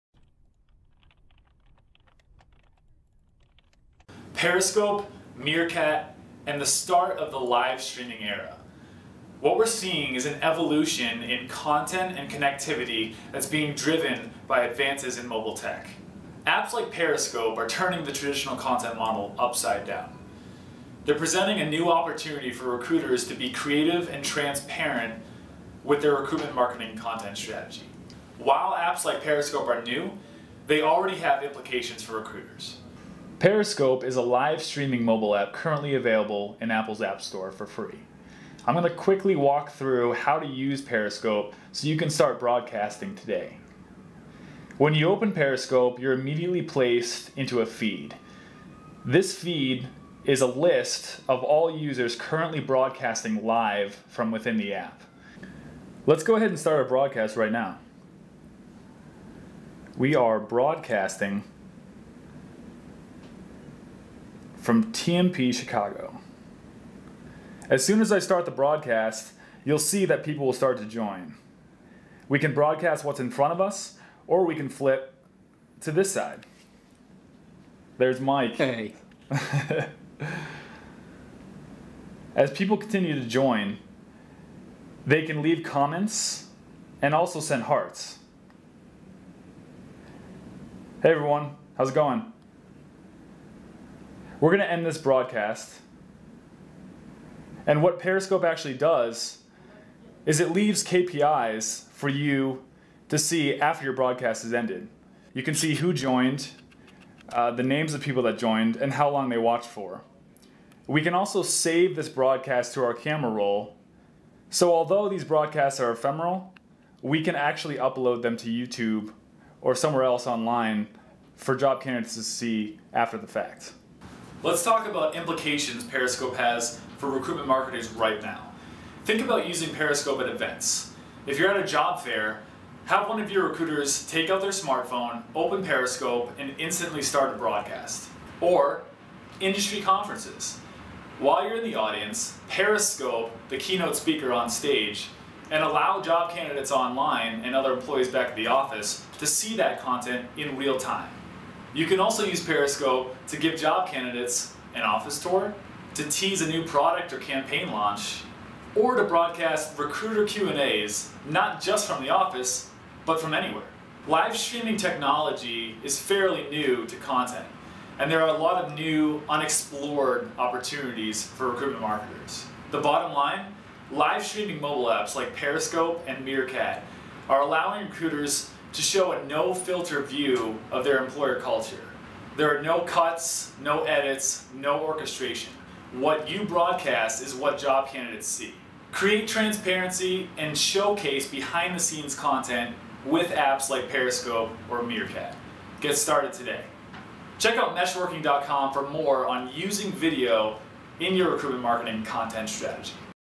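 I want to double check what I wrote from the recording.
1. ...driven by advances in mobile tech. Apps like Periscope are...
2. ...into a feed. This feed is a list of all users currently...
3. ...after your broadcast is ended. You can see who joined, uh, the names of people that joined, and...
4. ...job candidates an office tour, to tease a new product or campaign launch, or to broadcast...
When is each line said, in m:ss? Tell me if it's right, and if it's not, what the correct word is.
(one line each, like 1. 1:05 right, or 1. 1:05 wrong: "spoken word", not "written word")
1. 0:13 right
2. 0:47 right
3. 1:43 right
4. 2:33 right.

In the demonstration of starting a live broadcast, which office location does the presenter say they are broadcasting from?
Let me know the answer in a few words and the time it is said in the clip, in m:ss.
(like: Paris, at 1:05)
TMP Chicago, at 1:04.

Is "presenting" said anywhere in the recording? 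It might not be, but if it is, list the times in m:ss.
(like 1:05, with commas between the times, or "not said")
0:21.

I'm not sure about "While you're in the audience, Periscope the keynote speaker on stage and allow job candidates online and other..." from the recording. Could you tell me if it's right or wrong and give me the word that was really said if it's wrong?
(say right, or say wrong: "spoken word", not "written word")
right.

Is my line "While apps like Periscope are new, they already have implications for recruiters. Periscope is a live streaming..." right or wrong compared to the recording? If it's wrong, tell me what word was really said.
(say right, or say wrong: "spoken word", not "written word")
right.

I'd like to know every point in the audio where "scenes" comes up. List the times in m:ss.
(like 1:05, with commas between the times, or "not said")
3:11.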